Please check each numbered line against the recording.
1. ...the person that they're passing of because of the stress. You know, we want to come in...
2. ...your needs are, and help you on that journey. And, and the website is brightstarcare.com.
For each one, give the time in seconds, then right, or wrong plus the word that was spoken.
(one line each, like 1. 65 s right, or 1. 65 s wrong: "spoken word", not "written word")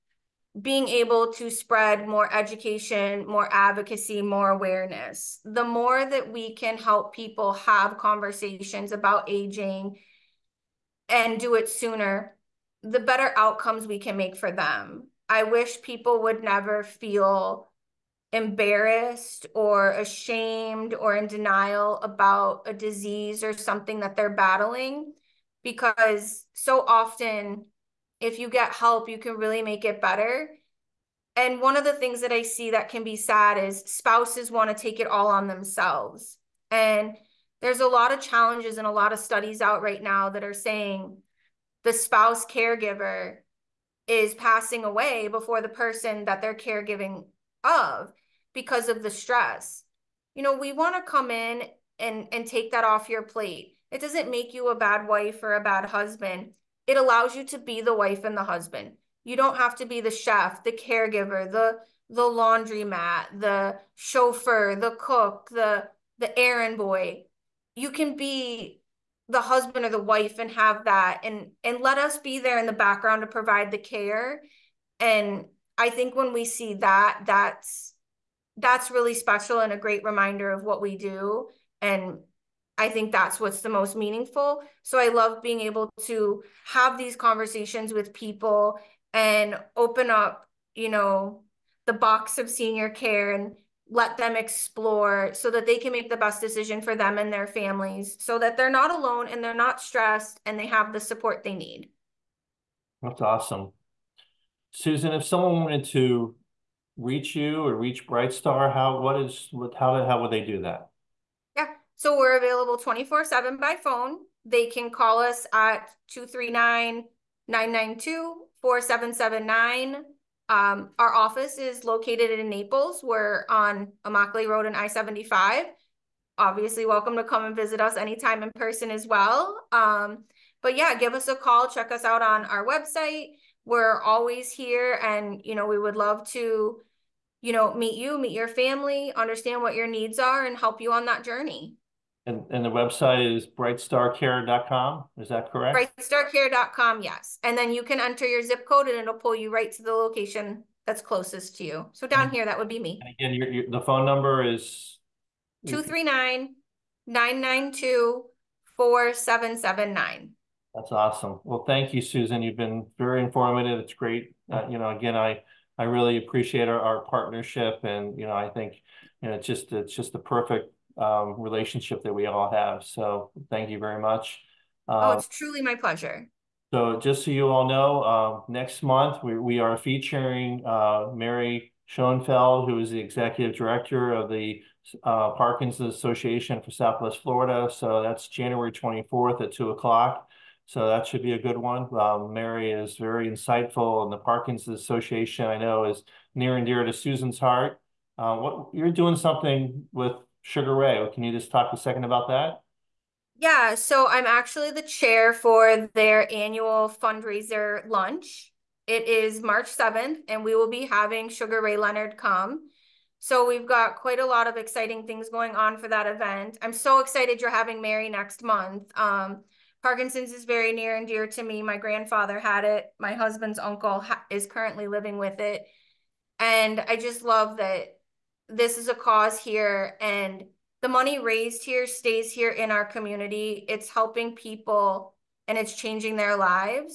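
1. 45 s wrong: "caregiving", not "passing"
2. 139 s right.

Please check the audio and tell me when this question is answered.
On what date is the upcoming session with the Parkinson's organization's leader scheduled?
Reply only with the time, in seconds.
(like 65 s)
188 s.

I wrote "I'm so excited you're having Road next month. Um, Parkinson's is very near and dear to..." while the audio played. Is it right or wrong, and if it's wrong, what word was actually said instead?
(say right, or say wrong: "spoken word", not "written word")
wrong: "Mary", not "Road".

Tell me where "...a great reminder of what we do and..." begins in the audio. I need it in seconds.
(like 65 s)
79 s.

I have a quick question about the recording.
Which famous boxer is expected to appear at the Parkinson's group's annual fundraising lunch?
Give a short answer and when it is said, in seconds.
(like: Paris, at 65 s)
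Sugar Ray Leonard, at 211 s.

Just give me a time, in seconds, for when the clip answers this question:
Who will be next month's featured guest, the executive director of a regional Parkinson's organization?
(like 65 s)
181 s.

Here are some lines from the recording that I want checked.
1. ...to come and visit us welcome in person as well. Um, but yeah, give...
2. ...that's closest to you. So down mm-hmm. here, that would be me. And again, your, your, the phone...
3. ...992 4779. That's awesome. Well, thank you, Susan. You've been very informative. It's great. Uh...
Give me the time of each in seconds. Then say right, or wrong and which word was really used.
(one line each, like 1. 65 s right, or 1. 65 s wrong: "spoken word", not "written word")
1. 127 s wrong: "anytime", not "welcome"
2. 150 s right
3. 157 s right.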